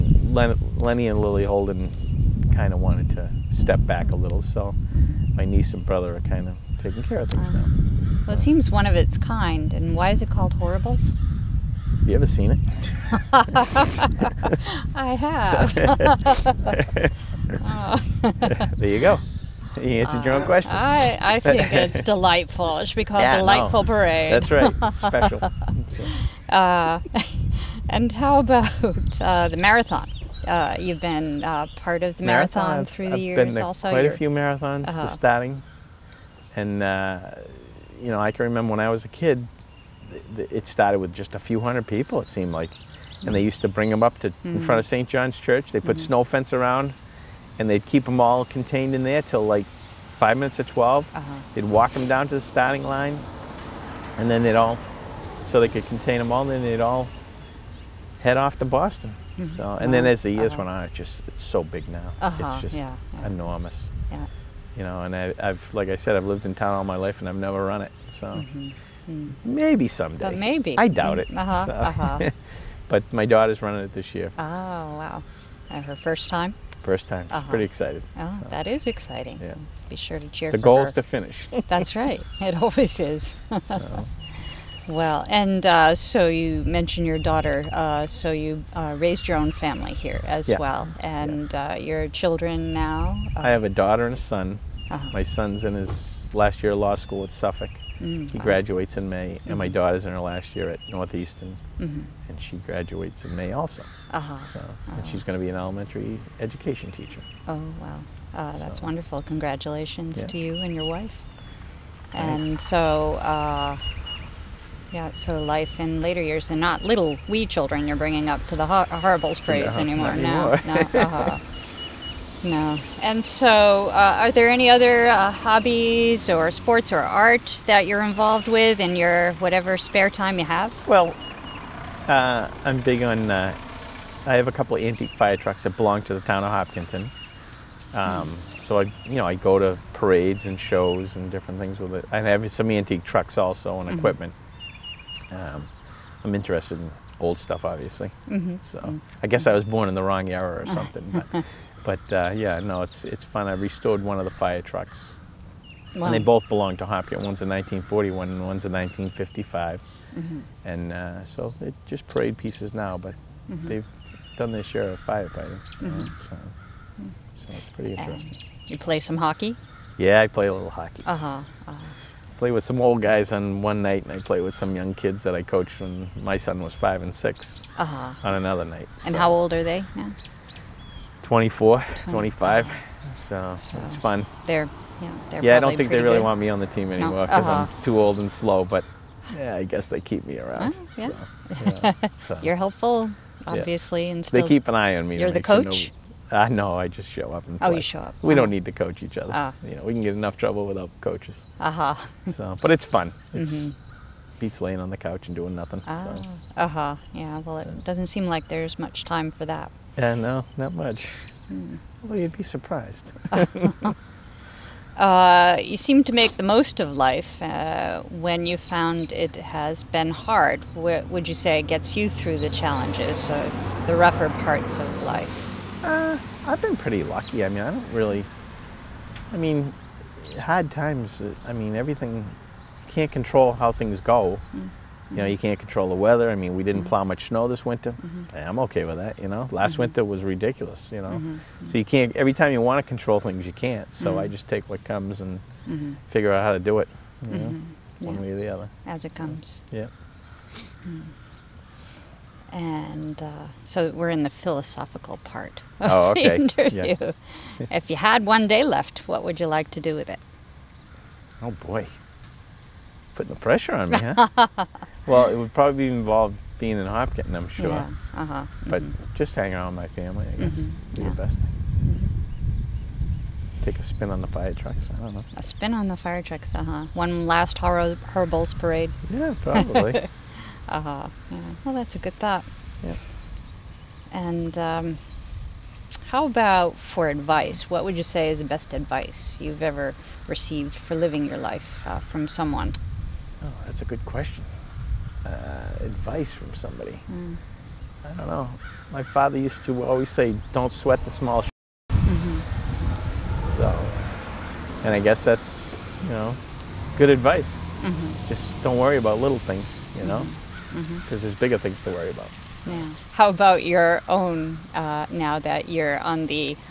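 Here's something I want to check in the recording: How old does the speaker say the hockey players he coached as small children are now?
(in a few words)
24, 25.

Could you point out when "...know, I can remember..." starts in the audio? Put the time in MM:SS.
00:38.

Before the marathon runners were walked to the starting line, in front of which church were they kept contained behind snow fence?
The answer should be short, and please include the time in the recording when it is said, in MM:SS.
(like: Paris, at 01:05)
St. John's Church, at 00:44.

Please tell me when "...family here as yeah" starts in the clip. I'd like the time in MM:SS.
01:29.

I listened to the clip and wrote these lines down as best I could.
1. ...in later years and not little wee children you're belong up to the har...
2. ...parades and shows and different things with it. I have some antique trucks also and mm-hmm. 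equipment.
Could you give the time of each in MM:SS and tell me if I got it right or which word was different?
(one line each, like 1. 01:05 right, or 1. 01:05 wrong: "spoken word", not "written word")
1. 01:55 wrong: "bringing", not "belong"
2. 02:19 right.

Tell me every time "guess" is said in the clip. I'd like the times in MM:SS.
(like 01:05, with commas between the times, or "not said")
02:29, 03:09, 04:30, 05:04.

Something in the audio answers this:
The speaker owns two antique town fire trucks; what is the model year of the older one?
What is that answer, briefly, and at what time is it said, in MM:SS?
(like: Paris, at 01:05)
1941, at 02:37.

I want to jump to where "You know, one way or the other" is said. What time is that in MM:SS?
04:07.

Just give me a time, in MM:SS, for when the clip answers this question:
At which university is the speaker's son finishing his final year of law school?
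01:37.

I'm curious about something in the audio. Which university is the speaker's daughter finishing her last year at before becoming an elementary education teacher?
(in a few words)
Northeastern.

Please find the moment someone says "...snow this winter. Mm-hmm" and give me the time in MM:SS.
03:57.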